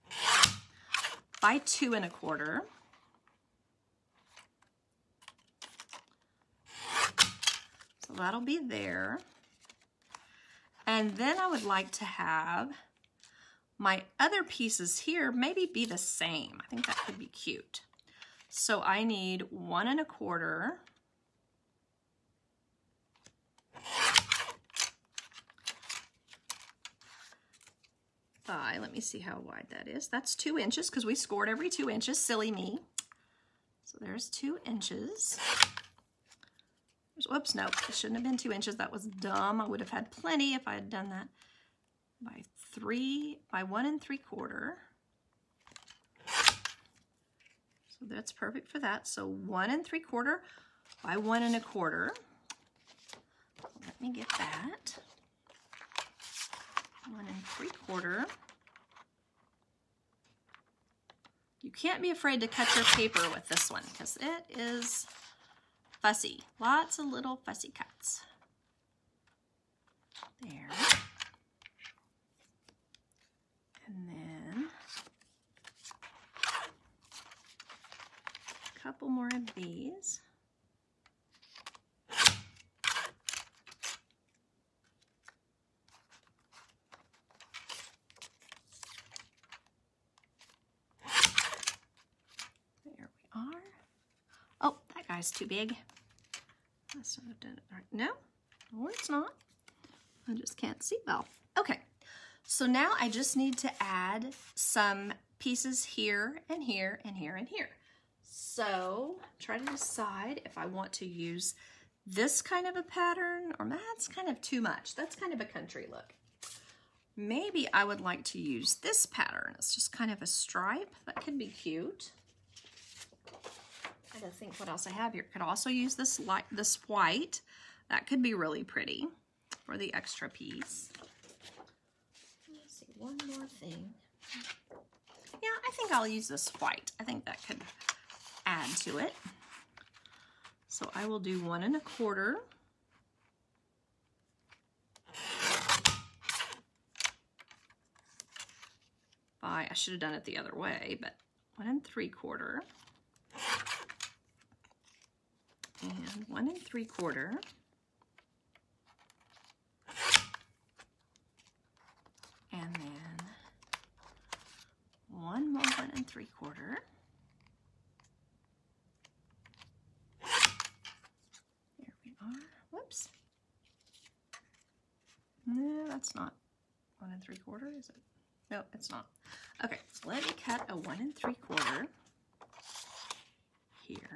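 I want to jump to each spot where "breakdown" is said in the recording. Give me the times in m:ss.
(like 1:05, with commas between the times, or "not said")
not said.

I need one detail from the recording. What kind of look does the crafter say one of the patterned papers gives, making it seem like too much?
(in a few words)
country look.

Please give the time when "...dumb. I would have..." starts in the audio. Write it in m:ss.
0:39.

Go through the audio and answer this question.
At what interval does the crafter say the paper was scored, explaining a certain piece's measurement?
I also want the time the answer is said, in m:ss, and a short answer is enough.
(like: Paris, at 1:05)
every 2 inches, at 0:31.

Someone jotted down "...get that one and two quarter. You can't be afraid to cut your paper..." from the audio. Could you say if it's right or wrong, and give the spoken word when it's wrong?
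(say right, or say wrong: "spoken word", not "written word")
wrong: "three", not "two".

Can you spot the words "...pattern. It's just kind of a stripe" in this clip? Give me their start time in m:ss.
1:59.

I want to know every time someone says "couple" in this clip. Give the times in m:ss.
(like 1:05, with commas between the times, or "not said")
1:18.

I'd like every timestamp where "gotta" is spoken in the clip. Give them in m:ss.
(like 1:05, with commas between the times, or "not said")
2:04.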